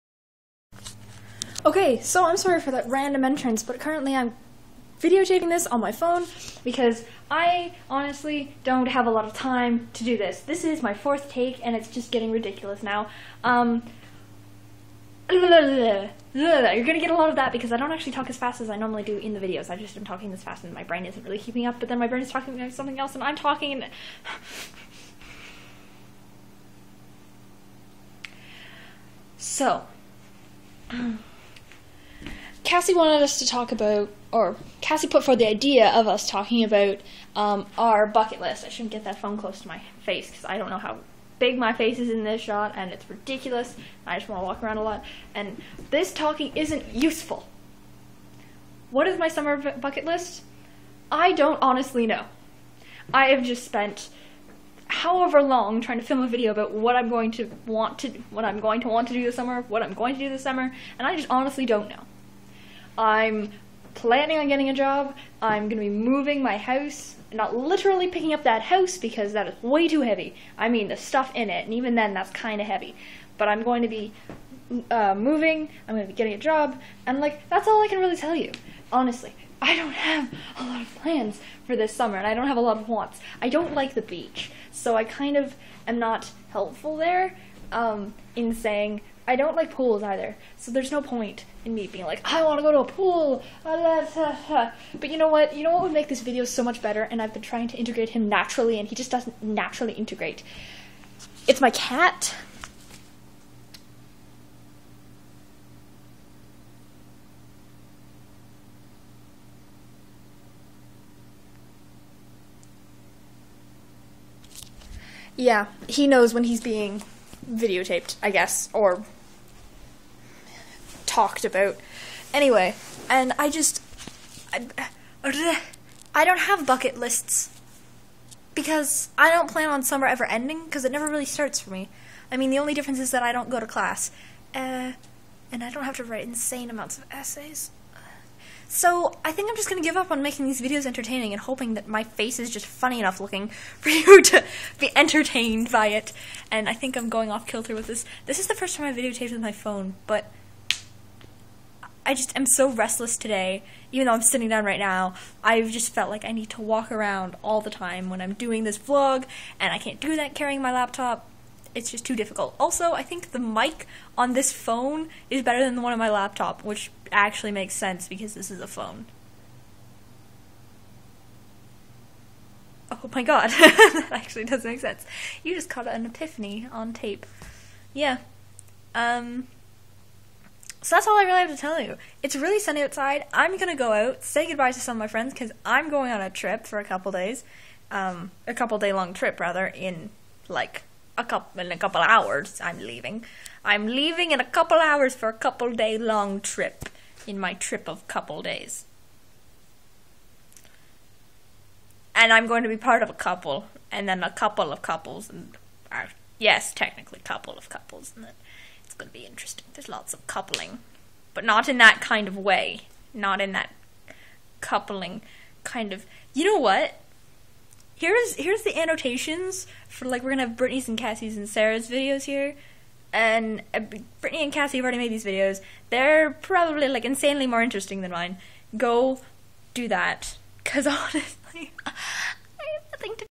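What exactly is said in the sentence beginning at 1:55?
Yeah, he knows when he's being videotaped, I guess, or talked about.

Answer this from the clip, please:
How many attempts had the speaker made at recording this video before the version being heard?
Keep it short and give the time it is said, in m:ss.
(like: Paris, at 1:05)
4, at 0:10.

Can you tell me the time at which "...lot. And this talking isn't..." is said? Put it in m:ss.
0:44.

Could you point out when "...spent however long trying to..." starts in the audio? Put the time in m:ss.
0:53.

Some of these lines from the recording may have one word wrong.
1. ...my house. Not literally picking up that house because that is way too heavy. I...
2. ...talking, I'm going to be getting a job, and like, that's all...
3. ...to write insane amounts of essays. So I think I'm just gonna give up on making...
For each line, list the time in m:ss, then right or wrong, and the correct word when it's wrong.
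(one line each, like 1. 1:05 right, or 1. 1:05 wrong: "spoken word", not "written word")
1. 1:06 right
2. 1:15 wrong: "moving", not "talking"
3. 2:15 right.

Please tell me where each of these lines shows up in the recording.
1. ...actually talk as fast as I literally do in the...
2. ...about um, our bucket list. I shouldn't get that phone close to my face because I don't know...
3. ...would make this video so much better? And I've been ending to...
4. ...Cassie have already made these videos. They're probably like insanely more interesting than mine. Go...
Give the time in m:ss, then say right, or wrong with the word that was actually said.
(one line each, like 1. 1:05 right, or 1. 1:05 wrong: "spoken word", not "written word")
1. 0:17 wrong: "normally", not "literally"
2. 0:36 right
3. 1:35 wrong: "trying", not "ending"
4. 3:44 right.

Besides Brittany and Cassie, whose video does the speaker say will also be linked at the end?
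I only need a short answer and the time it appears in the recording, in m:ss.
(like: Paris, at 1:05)
Sarah, at 3:41.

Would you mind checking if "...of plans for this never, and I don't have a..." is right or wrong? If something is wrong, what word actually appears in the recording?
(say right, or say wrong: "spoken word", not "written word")
wrong: "summer", not "never".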